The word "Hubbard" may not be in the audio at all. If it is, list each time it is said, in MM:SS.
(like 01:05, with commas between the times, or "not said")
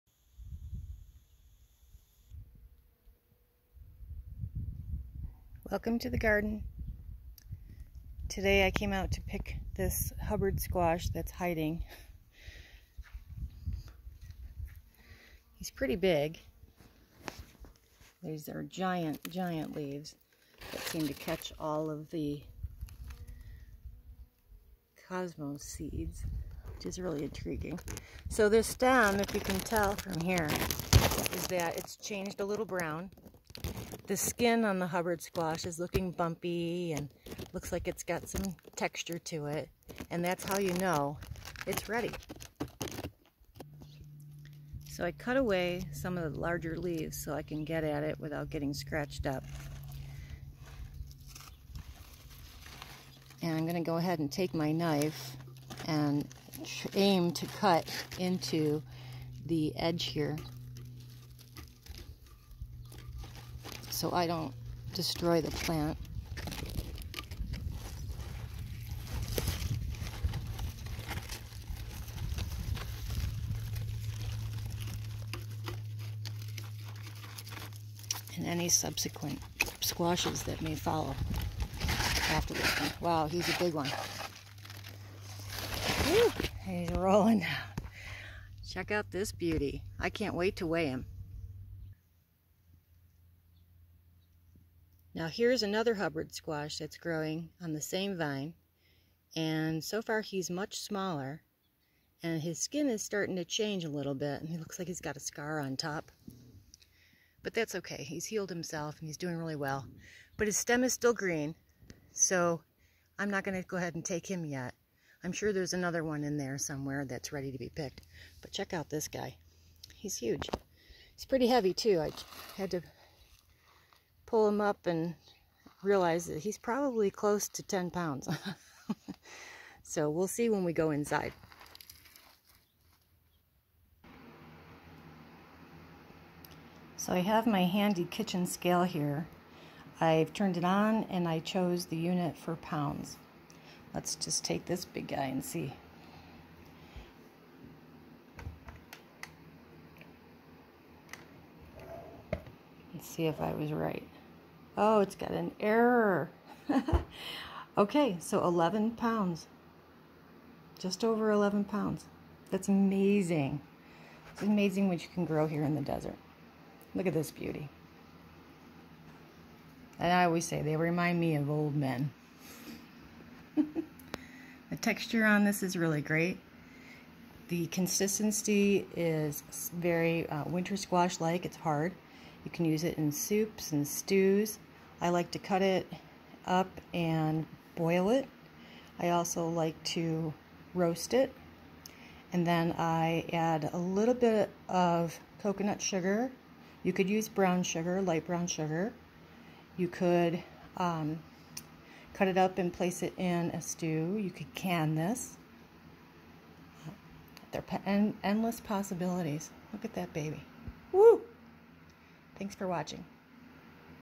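00:10, 00:34, 01:35.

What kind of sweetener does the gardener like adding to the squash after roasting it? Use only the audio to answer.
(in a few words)
Coconut sugar.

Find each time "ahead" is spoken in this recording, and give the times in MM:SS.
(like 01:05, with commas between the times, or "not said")
00:53, 01:53.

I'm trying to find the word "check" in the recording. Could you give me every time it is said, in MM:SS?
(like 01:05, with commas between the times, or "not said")
01:28, 01:58.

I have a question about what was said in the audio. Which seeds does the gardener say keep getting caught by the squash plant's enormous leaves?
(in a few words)
Cosmos seeds.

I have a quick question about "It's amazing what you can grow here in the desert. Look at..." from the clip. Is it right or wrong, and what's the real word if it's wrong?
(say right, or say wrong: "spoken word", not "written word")
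right.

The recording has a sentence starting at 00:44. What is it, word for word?
So I cut away some of the larger leaves so I can get at it without getting scratched up.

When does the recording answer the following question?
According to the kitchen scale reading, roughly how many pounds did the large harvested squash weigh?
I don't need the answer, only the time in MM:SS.
02:40.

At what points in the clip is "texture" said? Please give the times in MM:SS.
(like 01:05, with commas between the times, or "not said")
00:38, 02:54.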